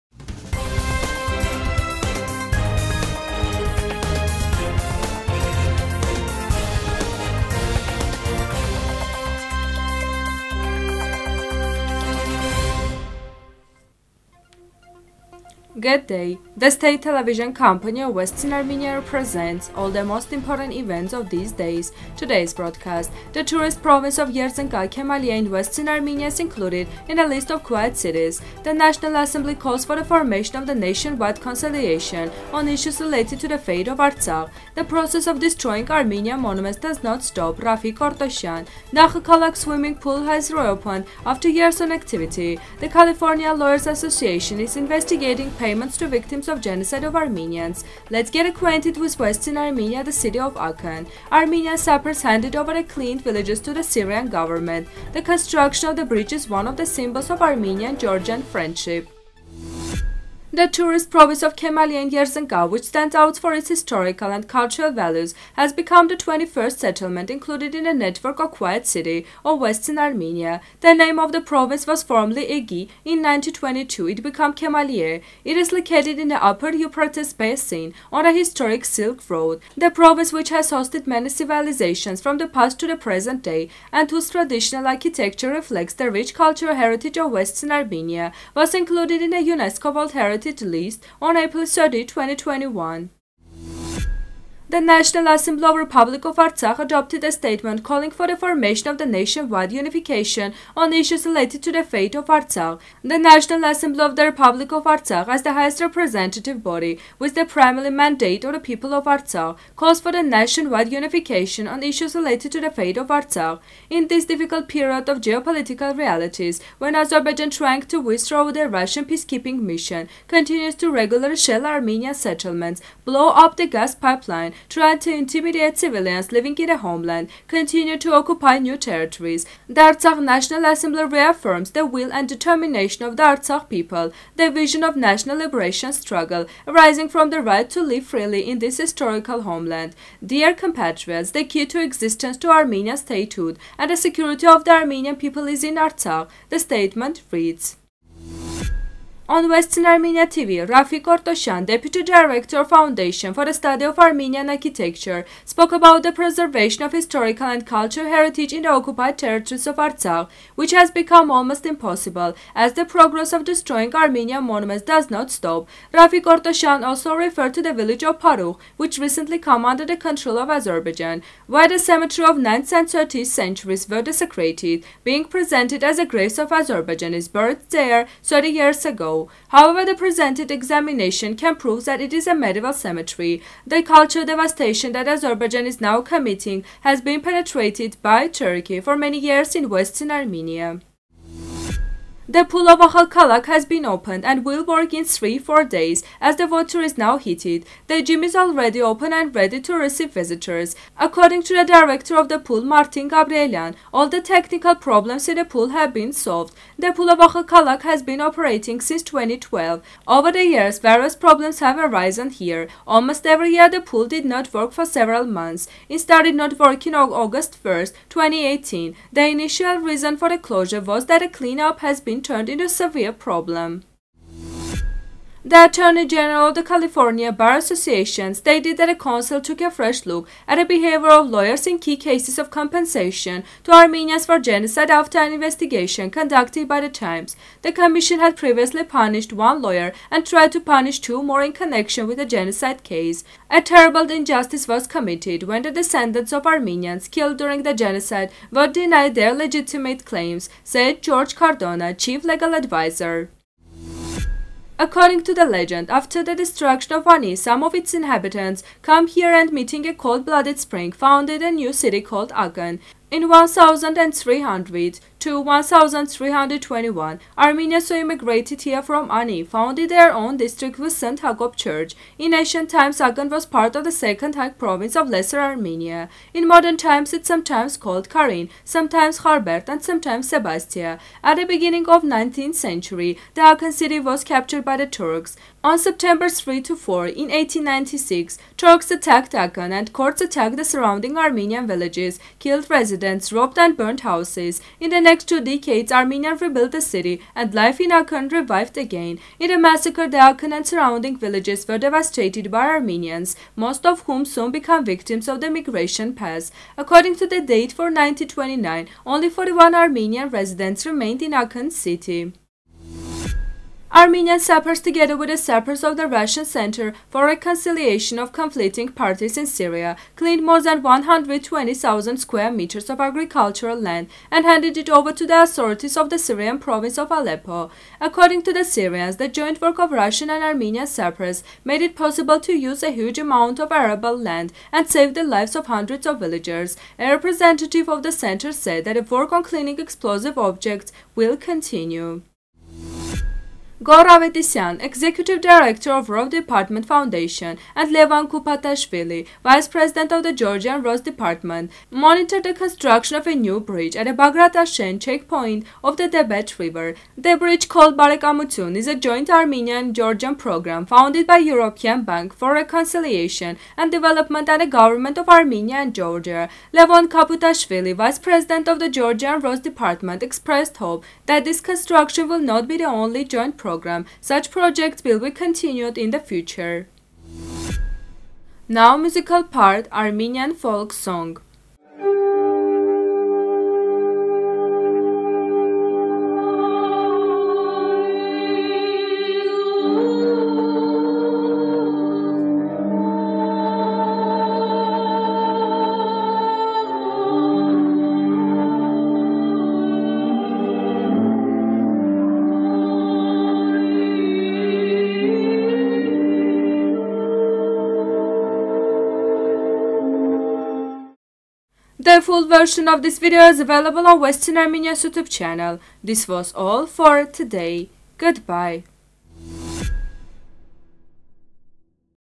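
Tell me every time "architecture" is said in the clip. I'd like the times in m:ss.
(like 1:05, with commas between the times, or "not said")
1:24, 2:34.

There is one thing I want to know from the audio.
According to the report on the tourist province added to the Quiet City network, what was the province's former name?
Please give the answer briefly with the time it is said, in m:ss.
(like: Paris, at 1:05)
Egi, at 1:12.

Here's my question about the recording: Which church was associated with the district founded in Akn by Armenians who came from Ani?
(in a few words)
St. Hakop Church.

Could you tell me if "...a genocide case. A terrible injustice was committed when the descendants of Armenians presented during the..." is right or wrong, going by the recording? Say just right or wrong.
wrong.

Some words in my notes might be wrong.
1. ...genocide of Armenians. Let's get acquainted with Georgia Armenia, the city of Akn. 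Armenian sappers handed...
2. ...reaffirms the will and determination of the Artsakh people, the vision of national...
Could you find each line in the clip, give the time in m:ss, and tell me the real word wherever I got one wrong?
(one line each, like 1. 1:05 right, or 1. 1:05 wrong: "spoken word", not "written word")
1. 0:46 wrong: "Western", not "Georgia"
2. 2:11 right.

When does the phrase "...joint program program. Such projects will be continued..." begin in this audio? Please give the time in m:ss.
6:13.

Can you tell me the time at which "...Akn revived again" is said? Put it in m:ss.
4:57.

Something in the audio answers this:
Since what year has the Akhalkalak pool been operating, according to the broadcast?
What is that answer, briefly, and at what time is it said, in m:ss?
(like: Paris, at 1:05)
2012, at 3:29.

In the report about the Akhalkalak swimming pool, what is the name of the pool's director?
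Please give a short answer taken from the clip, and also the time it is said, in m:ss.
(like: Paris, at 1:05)
Martin Gabrielian, at 3:22.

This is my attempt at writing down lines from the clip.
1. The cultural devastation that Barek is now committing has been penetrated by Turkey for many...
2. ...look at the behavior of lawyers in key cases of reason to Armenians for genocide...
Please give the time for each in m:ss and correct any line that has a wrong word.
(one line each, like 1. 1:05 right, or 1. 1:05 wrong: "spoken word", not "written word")
1. 3:03 wrong: "Azerbaijan", not "Barek"
2. 3:50 wrong: "compensation", not "reason".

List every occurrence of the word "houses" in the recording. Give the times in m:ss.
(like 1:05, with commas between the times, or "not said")
4:53.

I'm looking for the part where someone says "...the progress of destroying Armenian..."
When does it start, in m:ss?
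2:42.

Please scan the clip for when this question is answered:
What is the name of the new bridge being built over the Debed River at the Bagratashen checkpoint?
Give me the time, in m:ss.
5:57.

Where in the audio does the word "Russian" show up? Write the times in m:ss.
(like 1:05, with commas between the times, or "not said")
1:58, 5:16, 5:29.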